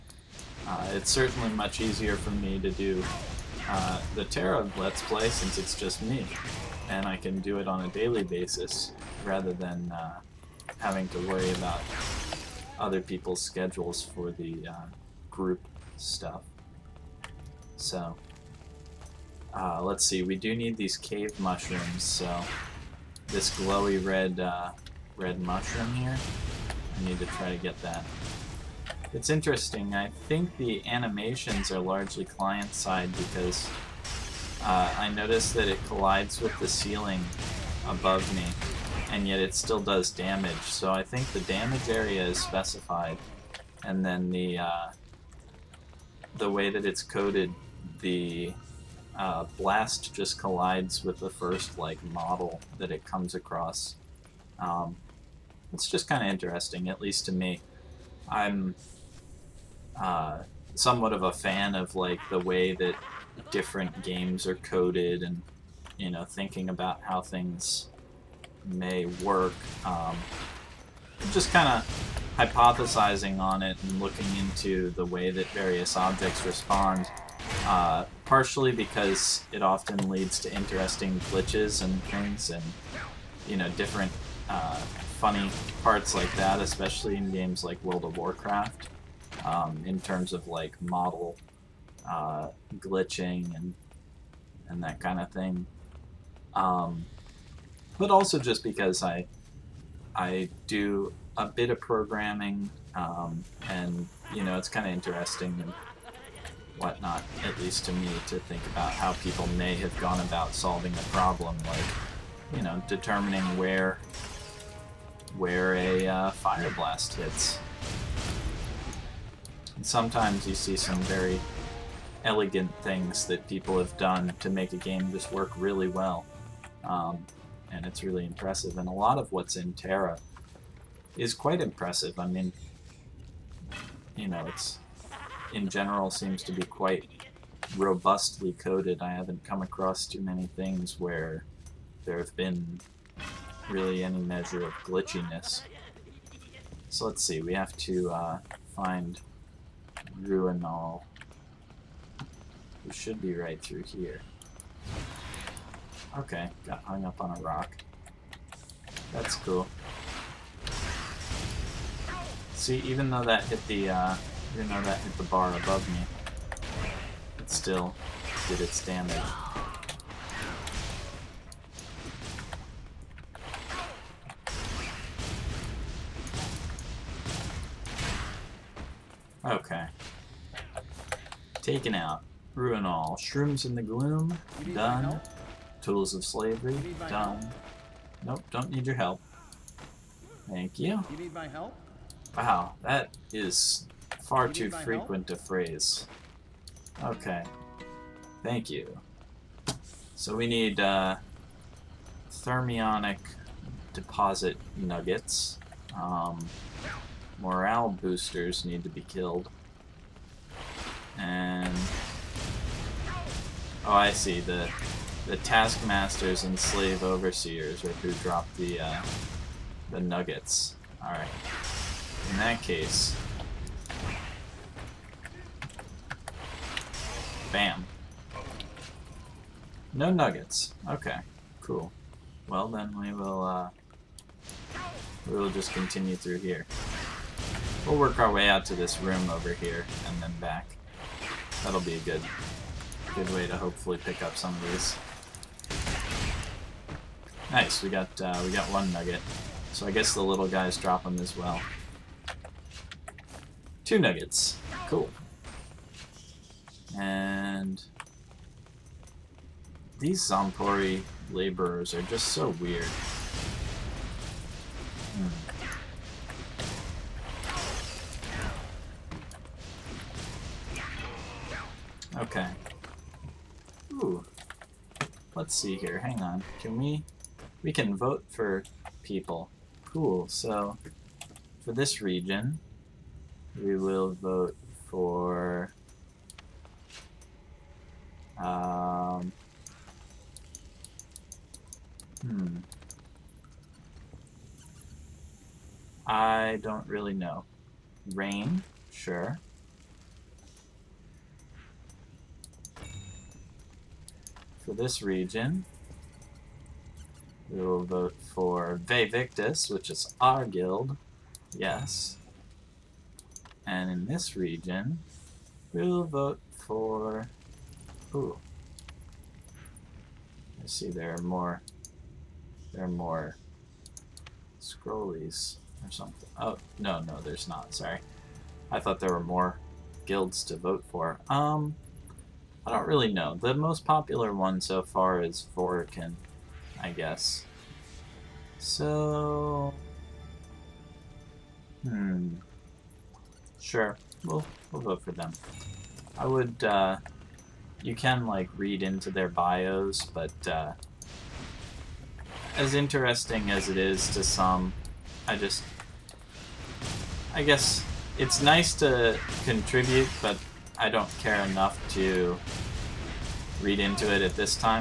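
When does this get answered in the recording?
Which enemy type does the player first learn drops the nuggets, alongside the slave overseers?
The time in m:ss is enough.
3:35.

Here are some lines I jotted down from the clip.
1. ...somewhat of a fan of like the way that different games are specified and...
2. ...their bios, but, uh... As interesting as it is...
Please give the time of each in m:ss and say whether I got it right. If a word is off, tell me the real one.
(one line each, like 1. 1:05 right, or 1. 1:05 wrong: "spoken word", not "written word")
1. 1:00 wrong: "coded", not "specified"
2. 5:49 right.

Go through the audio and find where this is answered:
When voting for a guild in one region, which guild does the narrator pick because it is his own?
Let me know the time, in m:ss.
5:08.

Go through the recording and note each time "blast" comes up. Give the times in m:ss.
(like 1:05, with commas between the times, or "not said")
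0:49, 1:56.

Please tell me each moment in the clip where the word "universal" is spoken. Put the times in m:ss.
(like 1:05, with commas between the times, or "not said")
not said.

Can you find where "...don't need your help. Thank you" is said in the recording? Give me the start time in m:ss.
3:08.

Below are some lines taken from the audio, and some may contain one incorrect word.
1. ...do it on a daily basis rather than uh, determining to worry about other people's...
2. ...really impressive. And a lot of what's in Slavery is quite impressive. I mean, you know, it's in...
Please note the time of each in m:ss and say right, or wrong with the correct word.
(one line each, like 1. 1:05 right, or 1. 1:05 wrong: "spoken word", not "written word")
1. 0:07 wrong: "having", not "determining"
2. 2:08 wrong: "Tera", not "Slavery".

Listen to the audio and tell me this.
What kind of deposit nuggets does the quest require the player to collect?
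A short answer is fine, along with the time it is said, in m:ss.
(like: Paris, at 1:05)
thermionic, at 3:22.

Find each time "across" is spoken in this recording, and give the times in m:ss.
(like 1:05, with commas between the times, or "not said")
0:53, 2:19.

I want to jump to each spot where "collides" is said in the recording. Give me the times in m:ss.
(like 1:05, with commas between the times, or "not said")
0:35, 0:50.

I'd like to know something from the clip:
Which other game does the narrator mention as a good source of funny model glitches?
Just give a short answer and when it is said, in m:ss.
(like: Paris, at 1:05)
World of Warcraft, at 1:27.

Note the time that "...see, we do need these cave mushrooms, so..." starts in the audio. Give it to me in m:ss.
0:20.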